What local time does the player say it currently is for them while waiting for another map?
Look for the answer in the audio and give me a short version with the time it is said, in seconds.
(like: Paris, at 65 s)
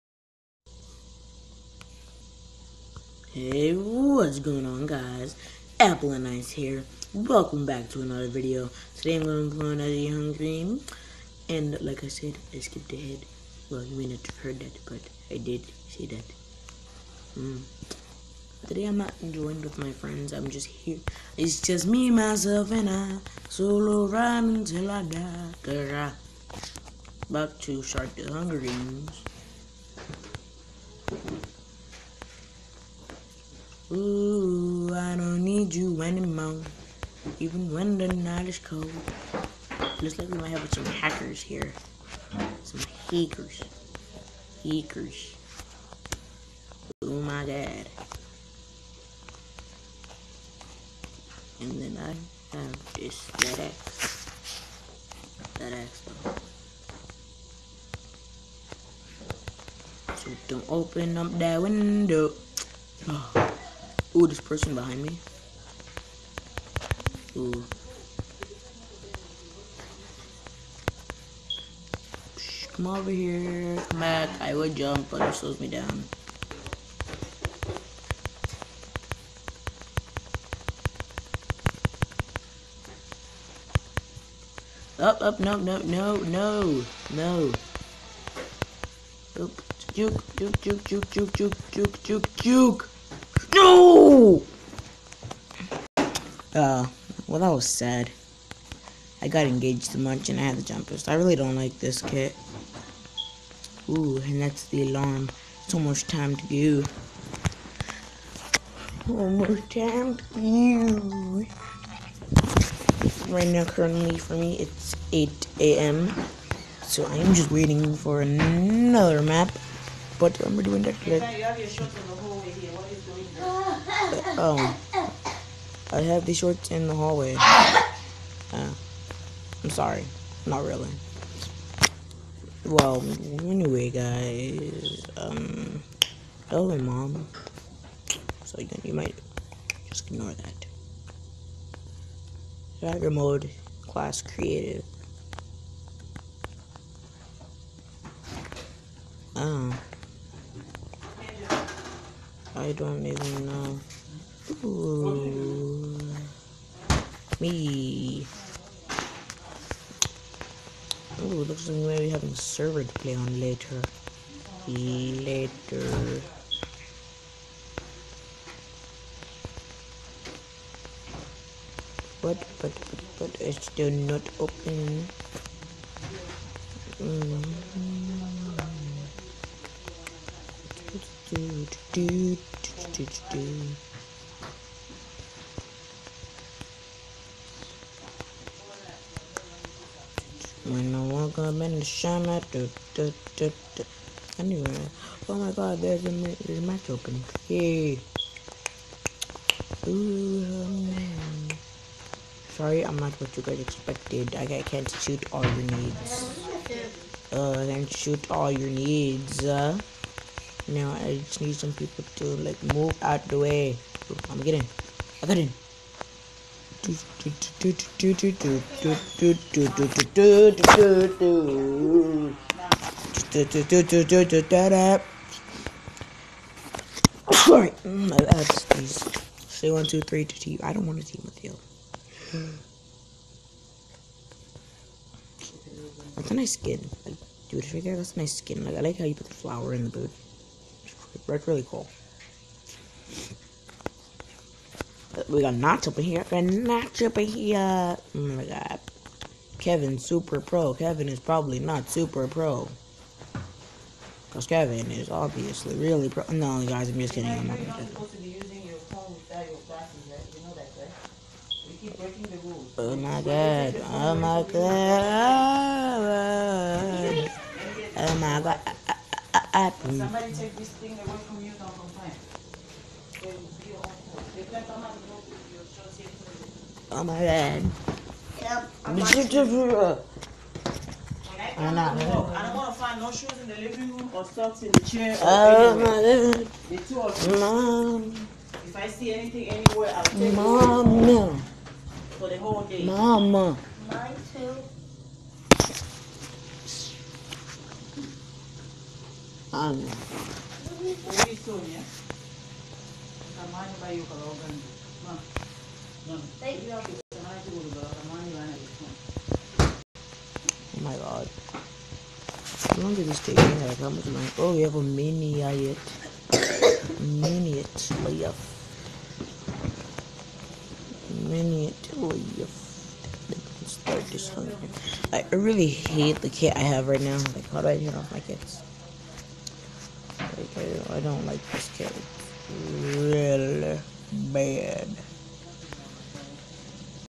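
8 a.m., at 115 s.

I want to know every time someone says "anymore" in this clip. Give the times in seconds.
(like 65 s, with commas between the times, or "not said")
36 s.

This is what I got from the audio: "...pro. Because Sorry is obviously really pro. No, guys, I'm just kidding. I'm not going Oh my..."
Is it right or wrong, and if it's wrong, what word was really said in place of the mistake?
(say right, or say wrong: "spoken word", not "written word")
wrong: "Kevin", not "Sorry".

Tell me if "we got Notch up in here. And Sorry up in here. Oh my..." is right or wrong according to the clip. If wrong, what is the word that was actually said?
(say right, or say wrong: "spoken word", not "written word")
wrong: "Notch", not "Sorry".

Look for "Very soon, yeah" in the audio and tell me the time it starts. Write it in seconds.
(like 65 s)
300 s.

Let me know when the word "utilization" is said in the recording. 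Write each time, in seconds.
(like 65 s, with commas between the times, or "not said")
not said.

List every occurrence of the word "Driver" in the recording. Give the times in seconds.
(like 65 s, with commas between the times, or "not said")
142 s.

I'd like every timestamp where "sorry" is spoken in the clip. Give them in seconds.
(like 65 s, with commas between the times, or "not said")
129 s, 202 s, 216 s.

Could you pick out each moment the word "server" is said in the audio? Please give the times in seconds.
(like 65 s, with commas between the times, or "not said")
162 s.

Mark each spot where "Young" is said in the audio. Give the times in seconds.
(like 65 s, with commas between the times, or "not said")
9 s.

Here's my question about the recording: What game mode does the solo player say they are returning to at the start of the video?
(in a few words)
Shark the Hunger Games.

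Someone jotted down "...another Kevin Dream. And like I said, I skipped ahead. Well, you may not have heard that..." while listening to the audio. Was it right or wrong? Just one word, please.
wrong.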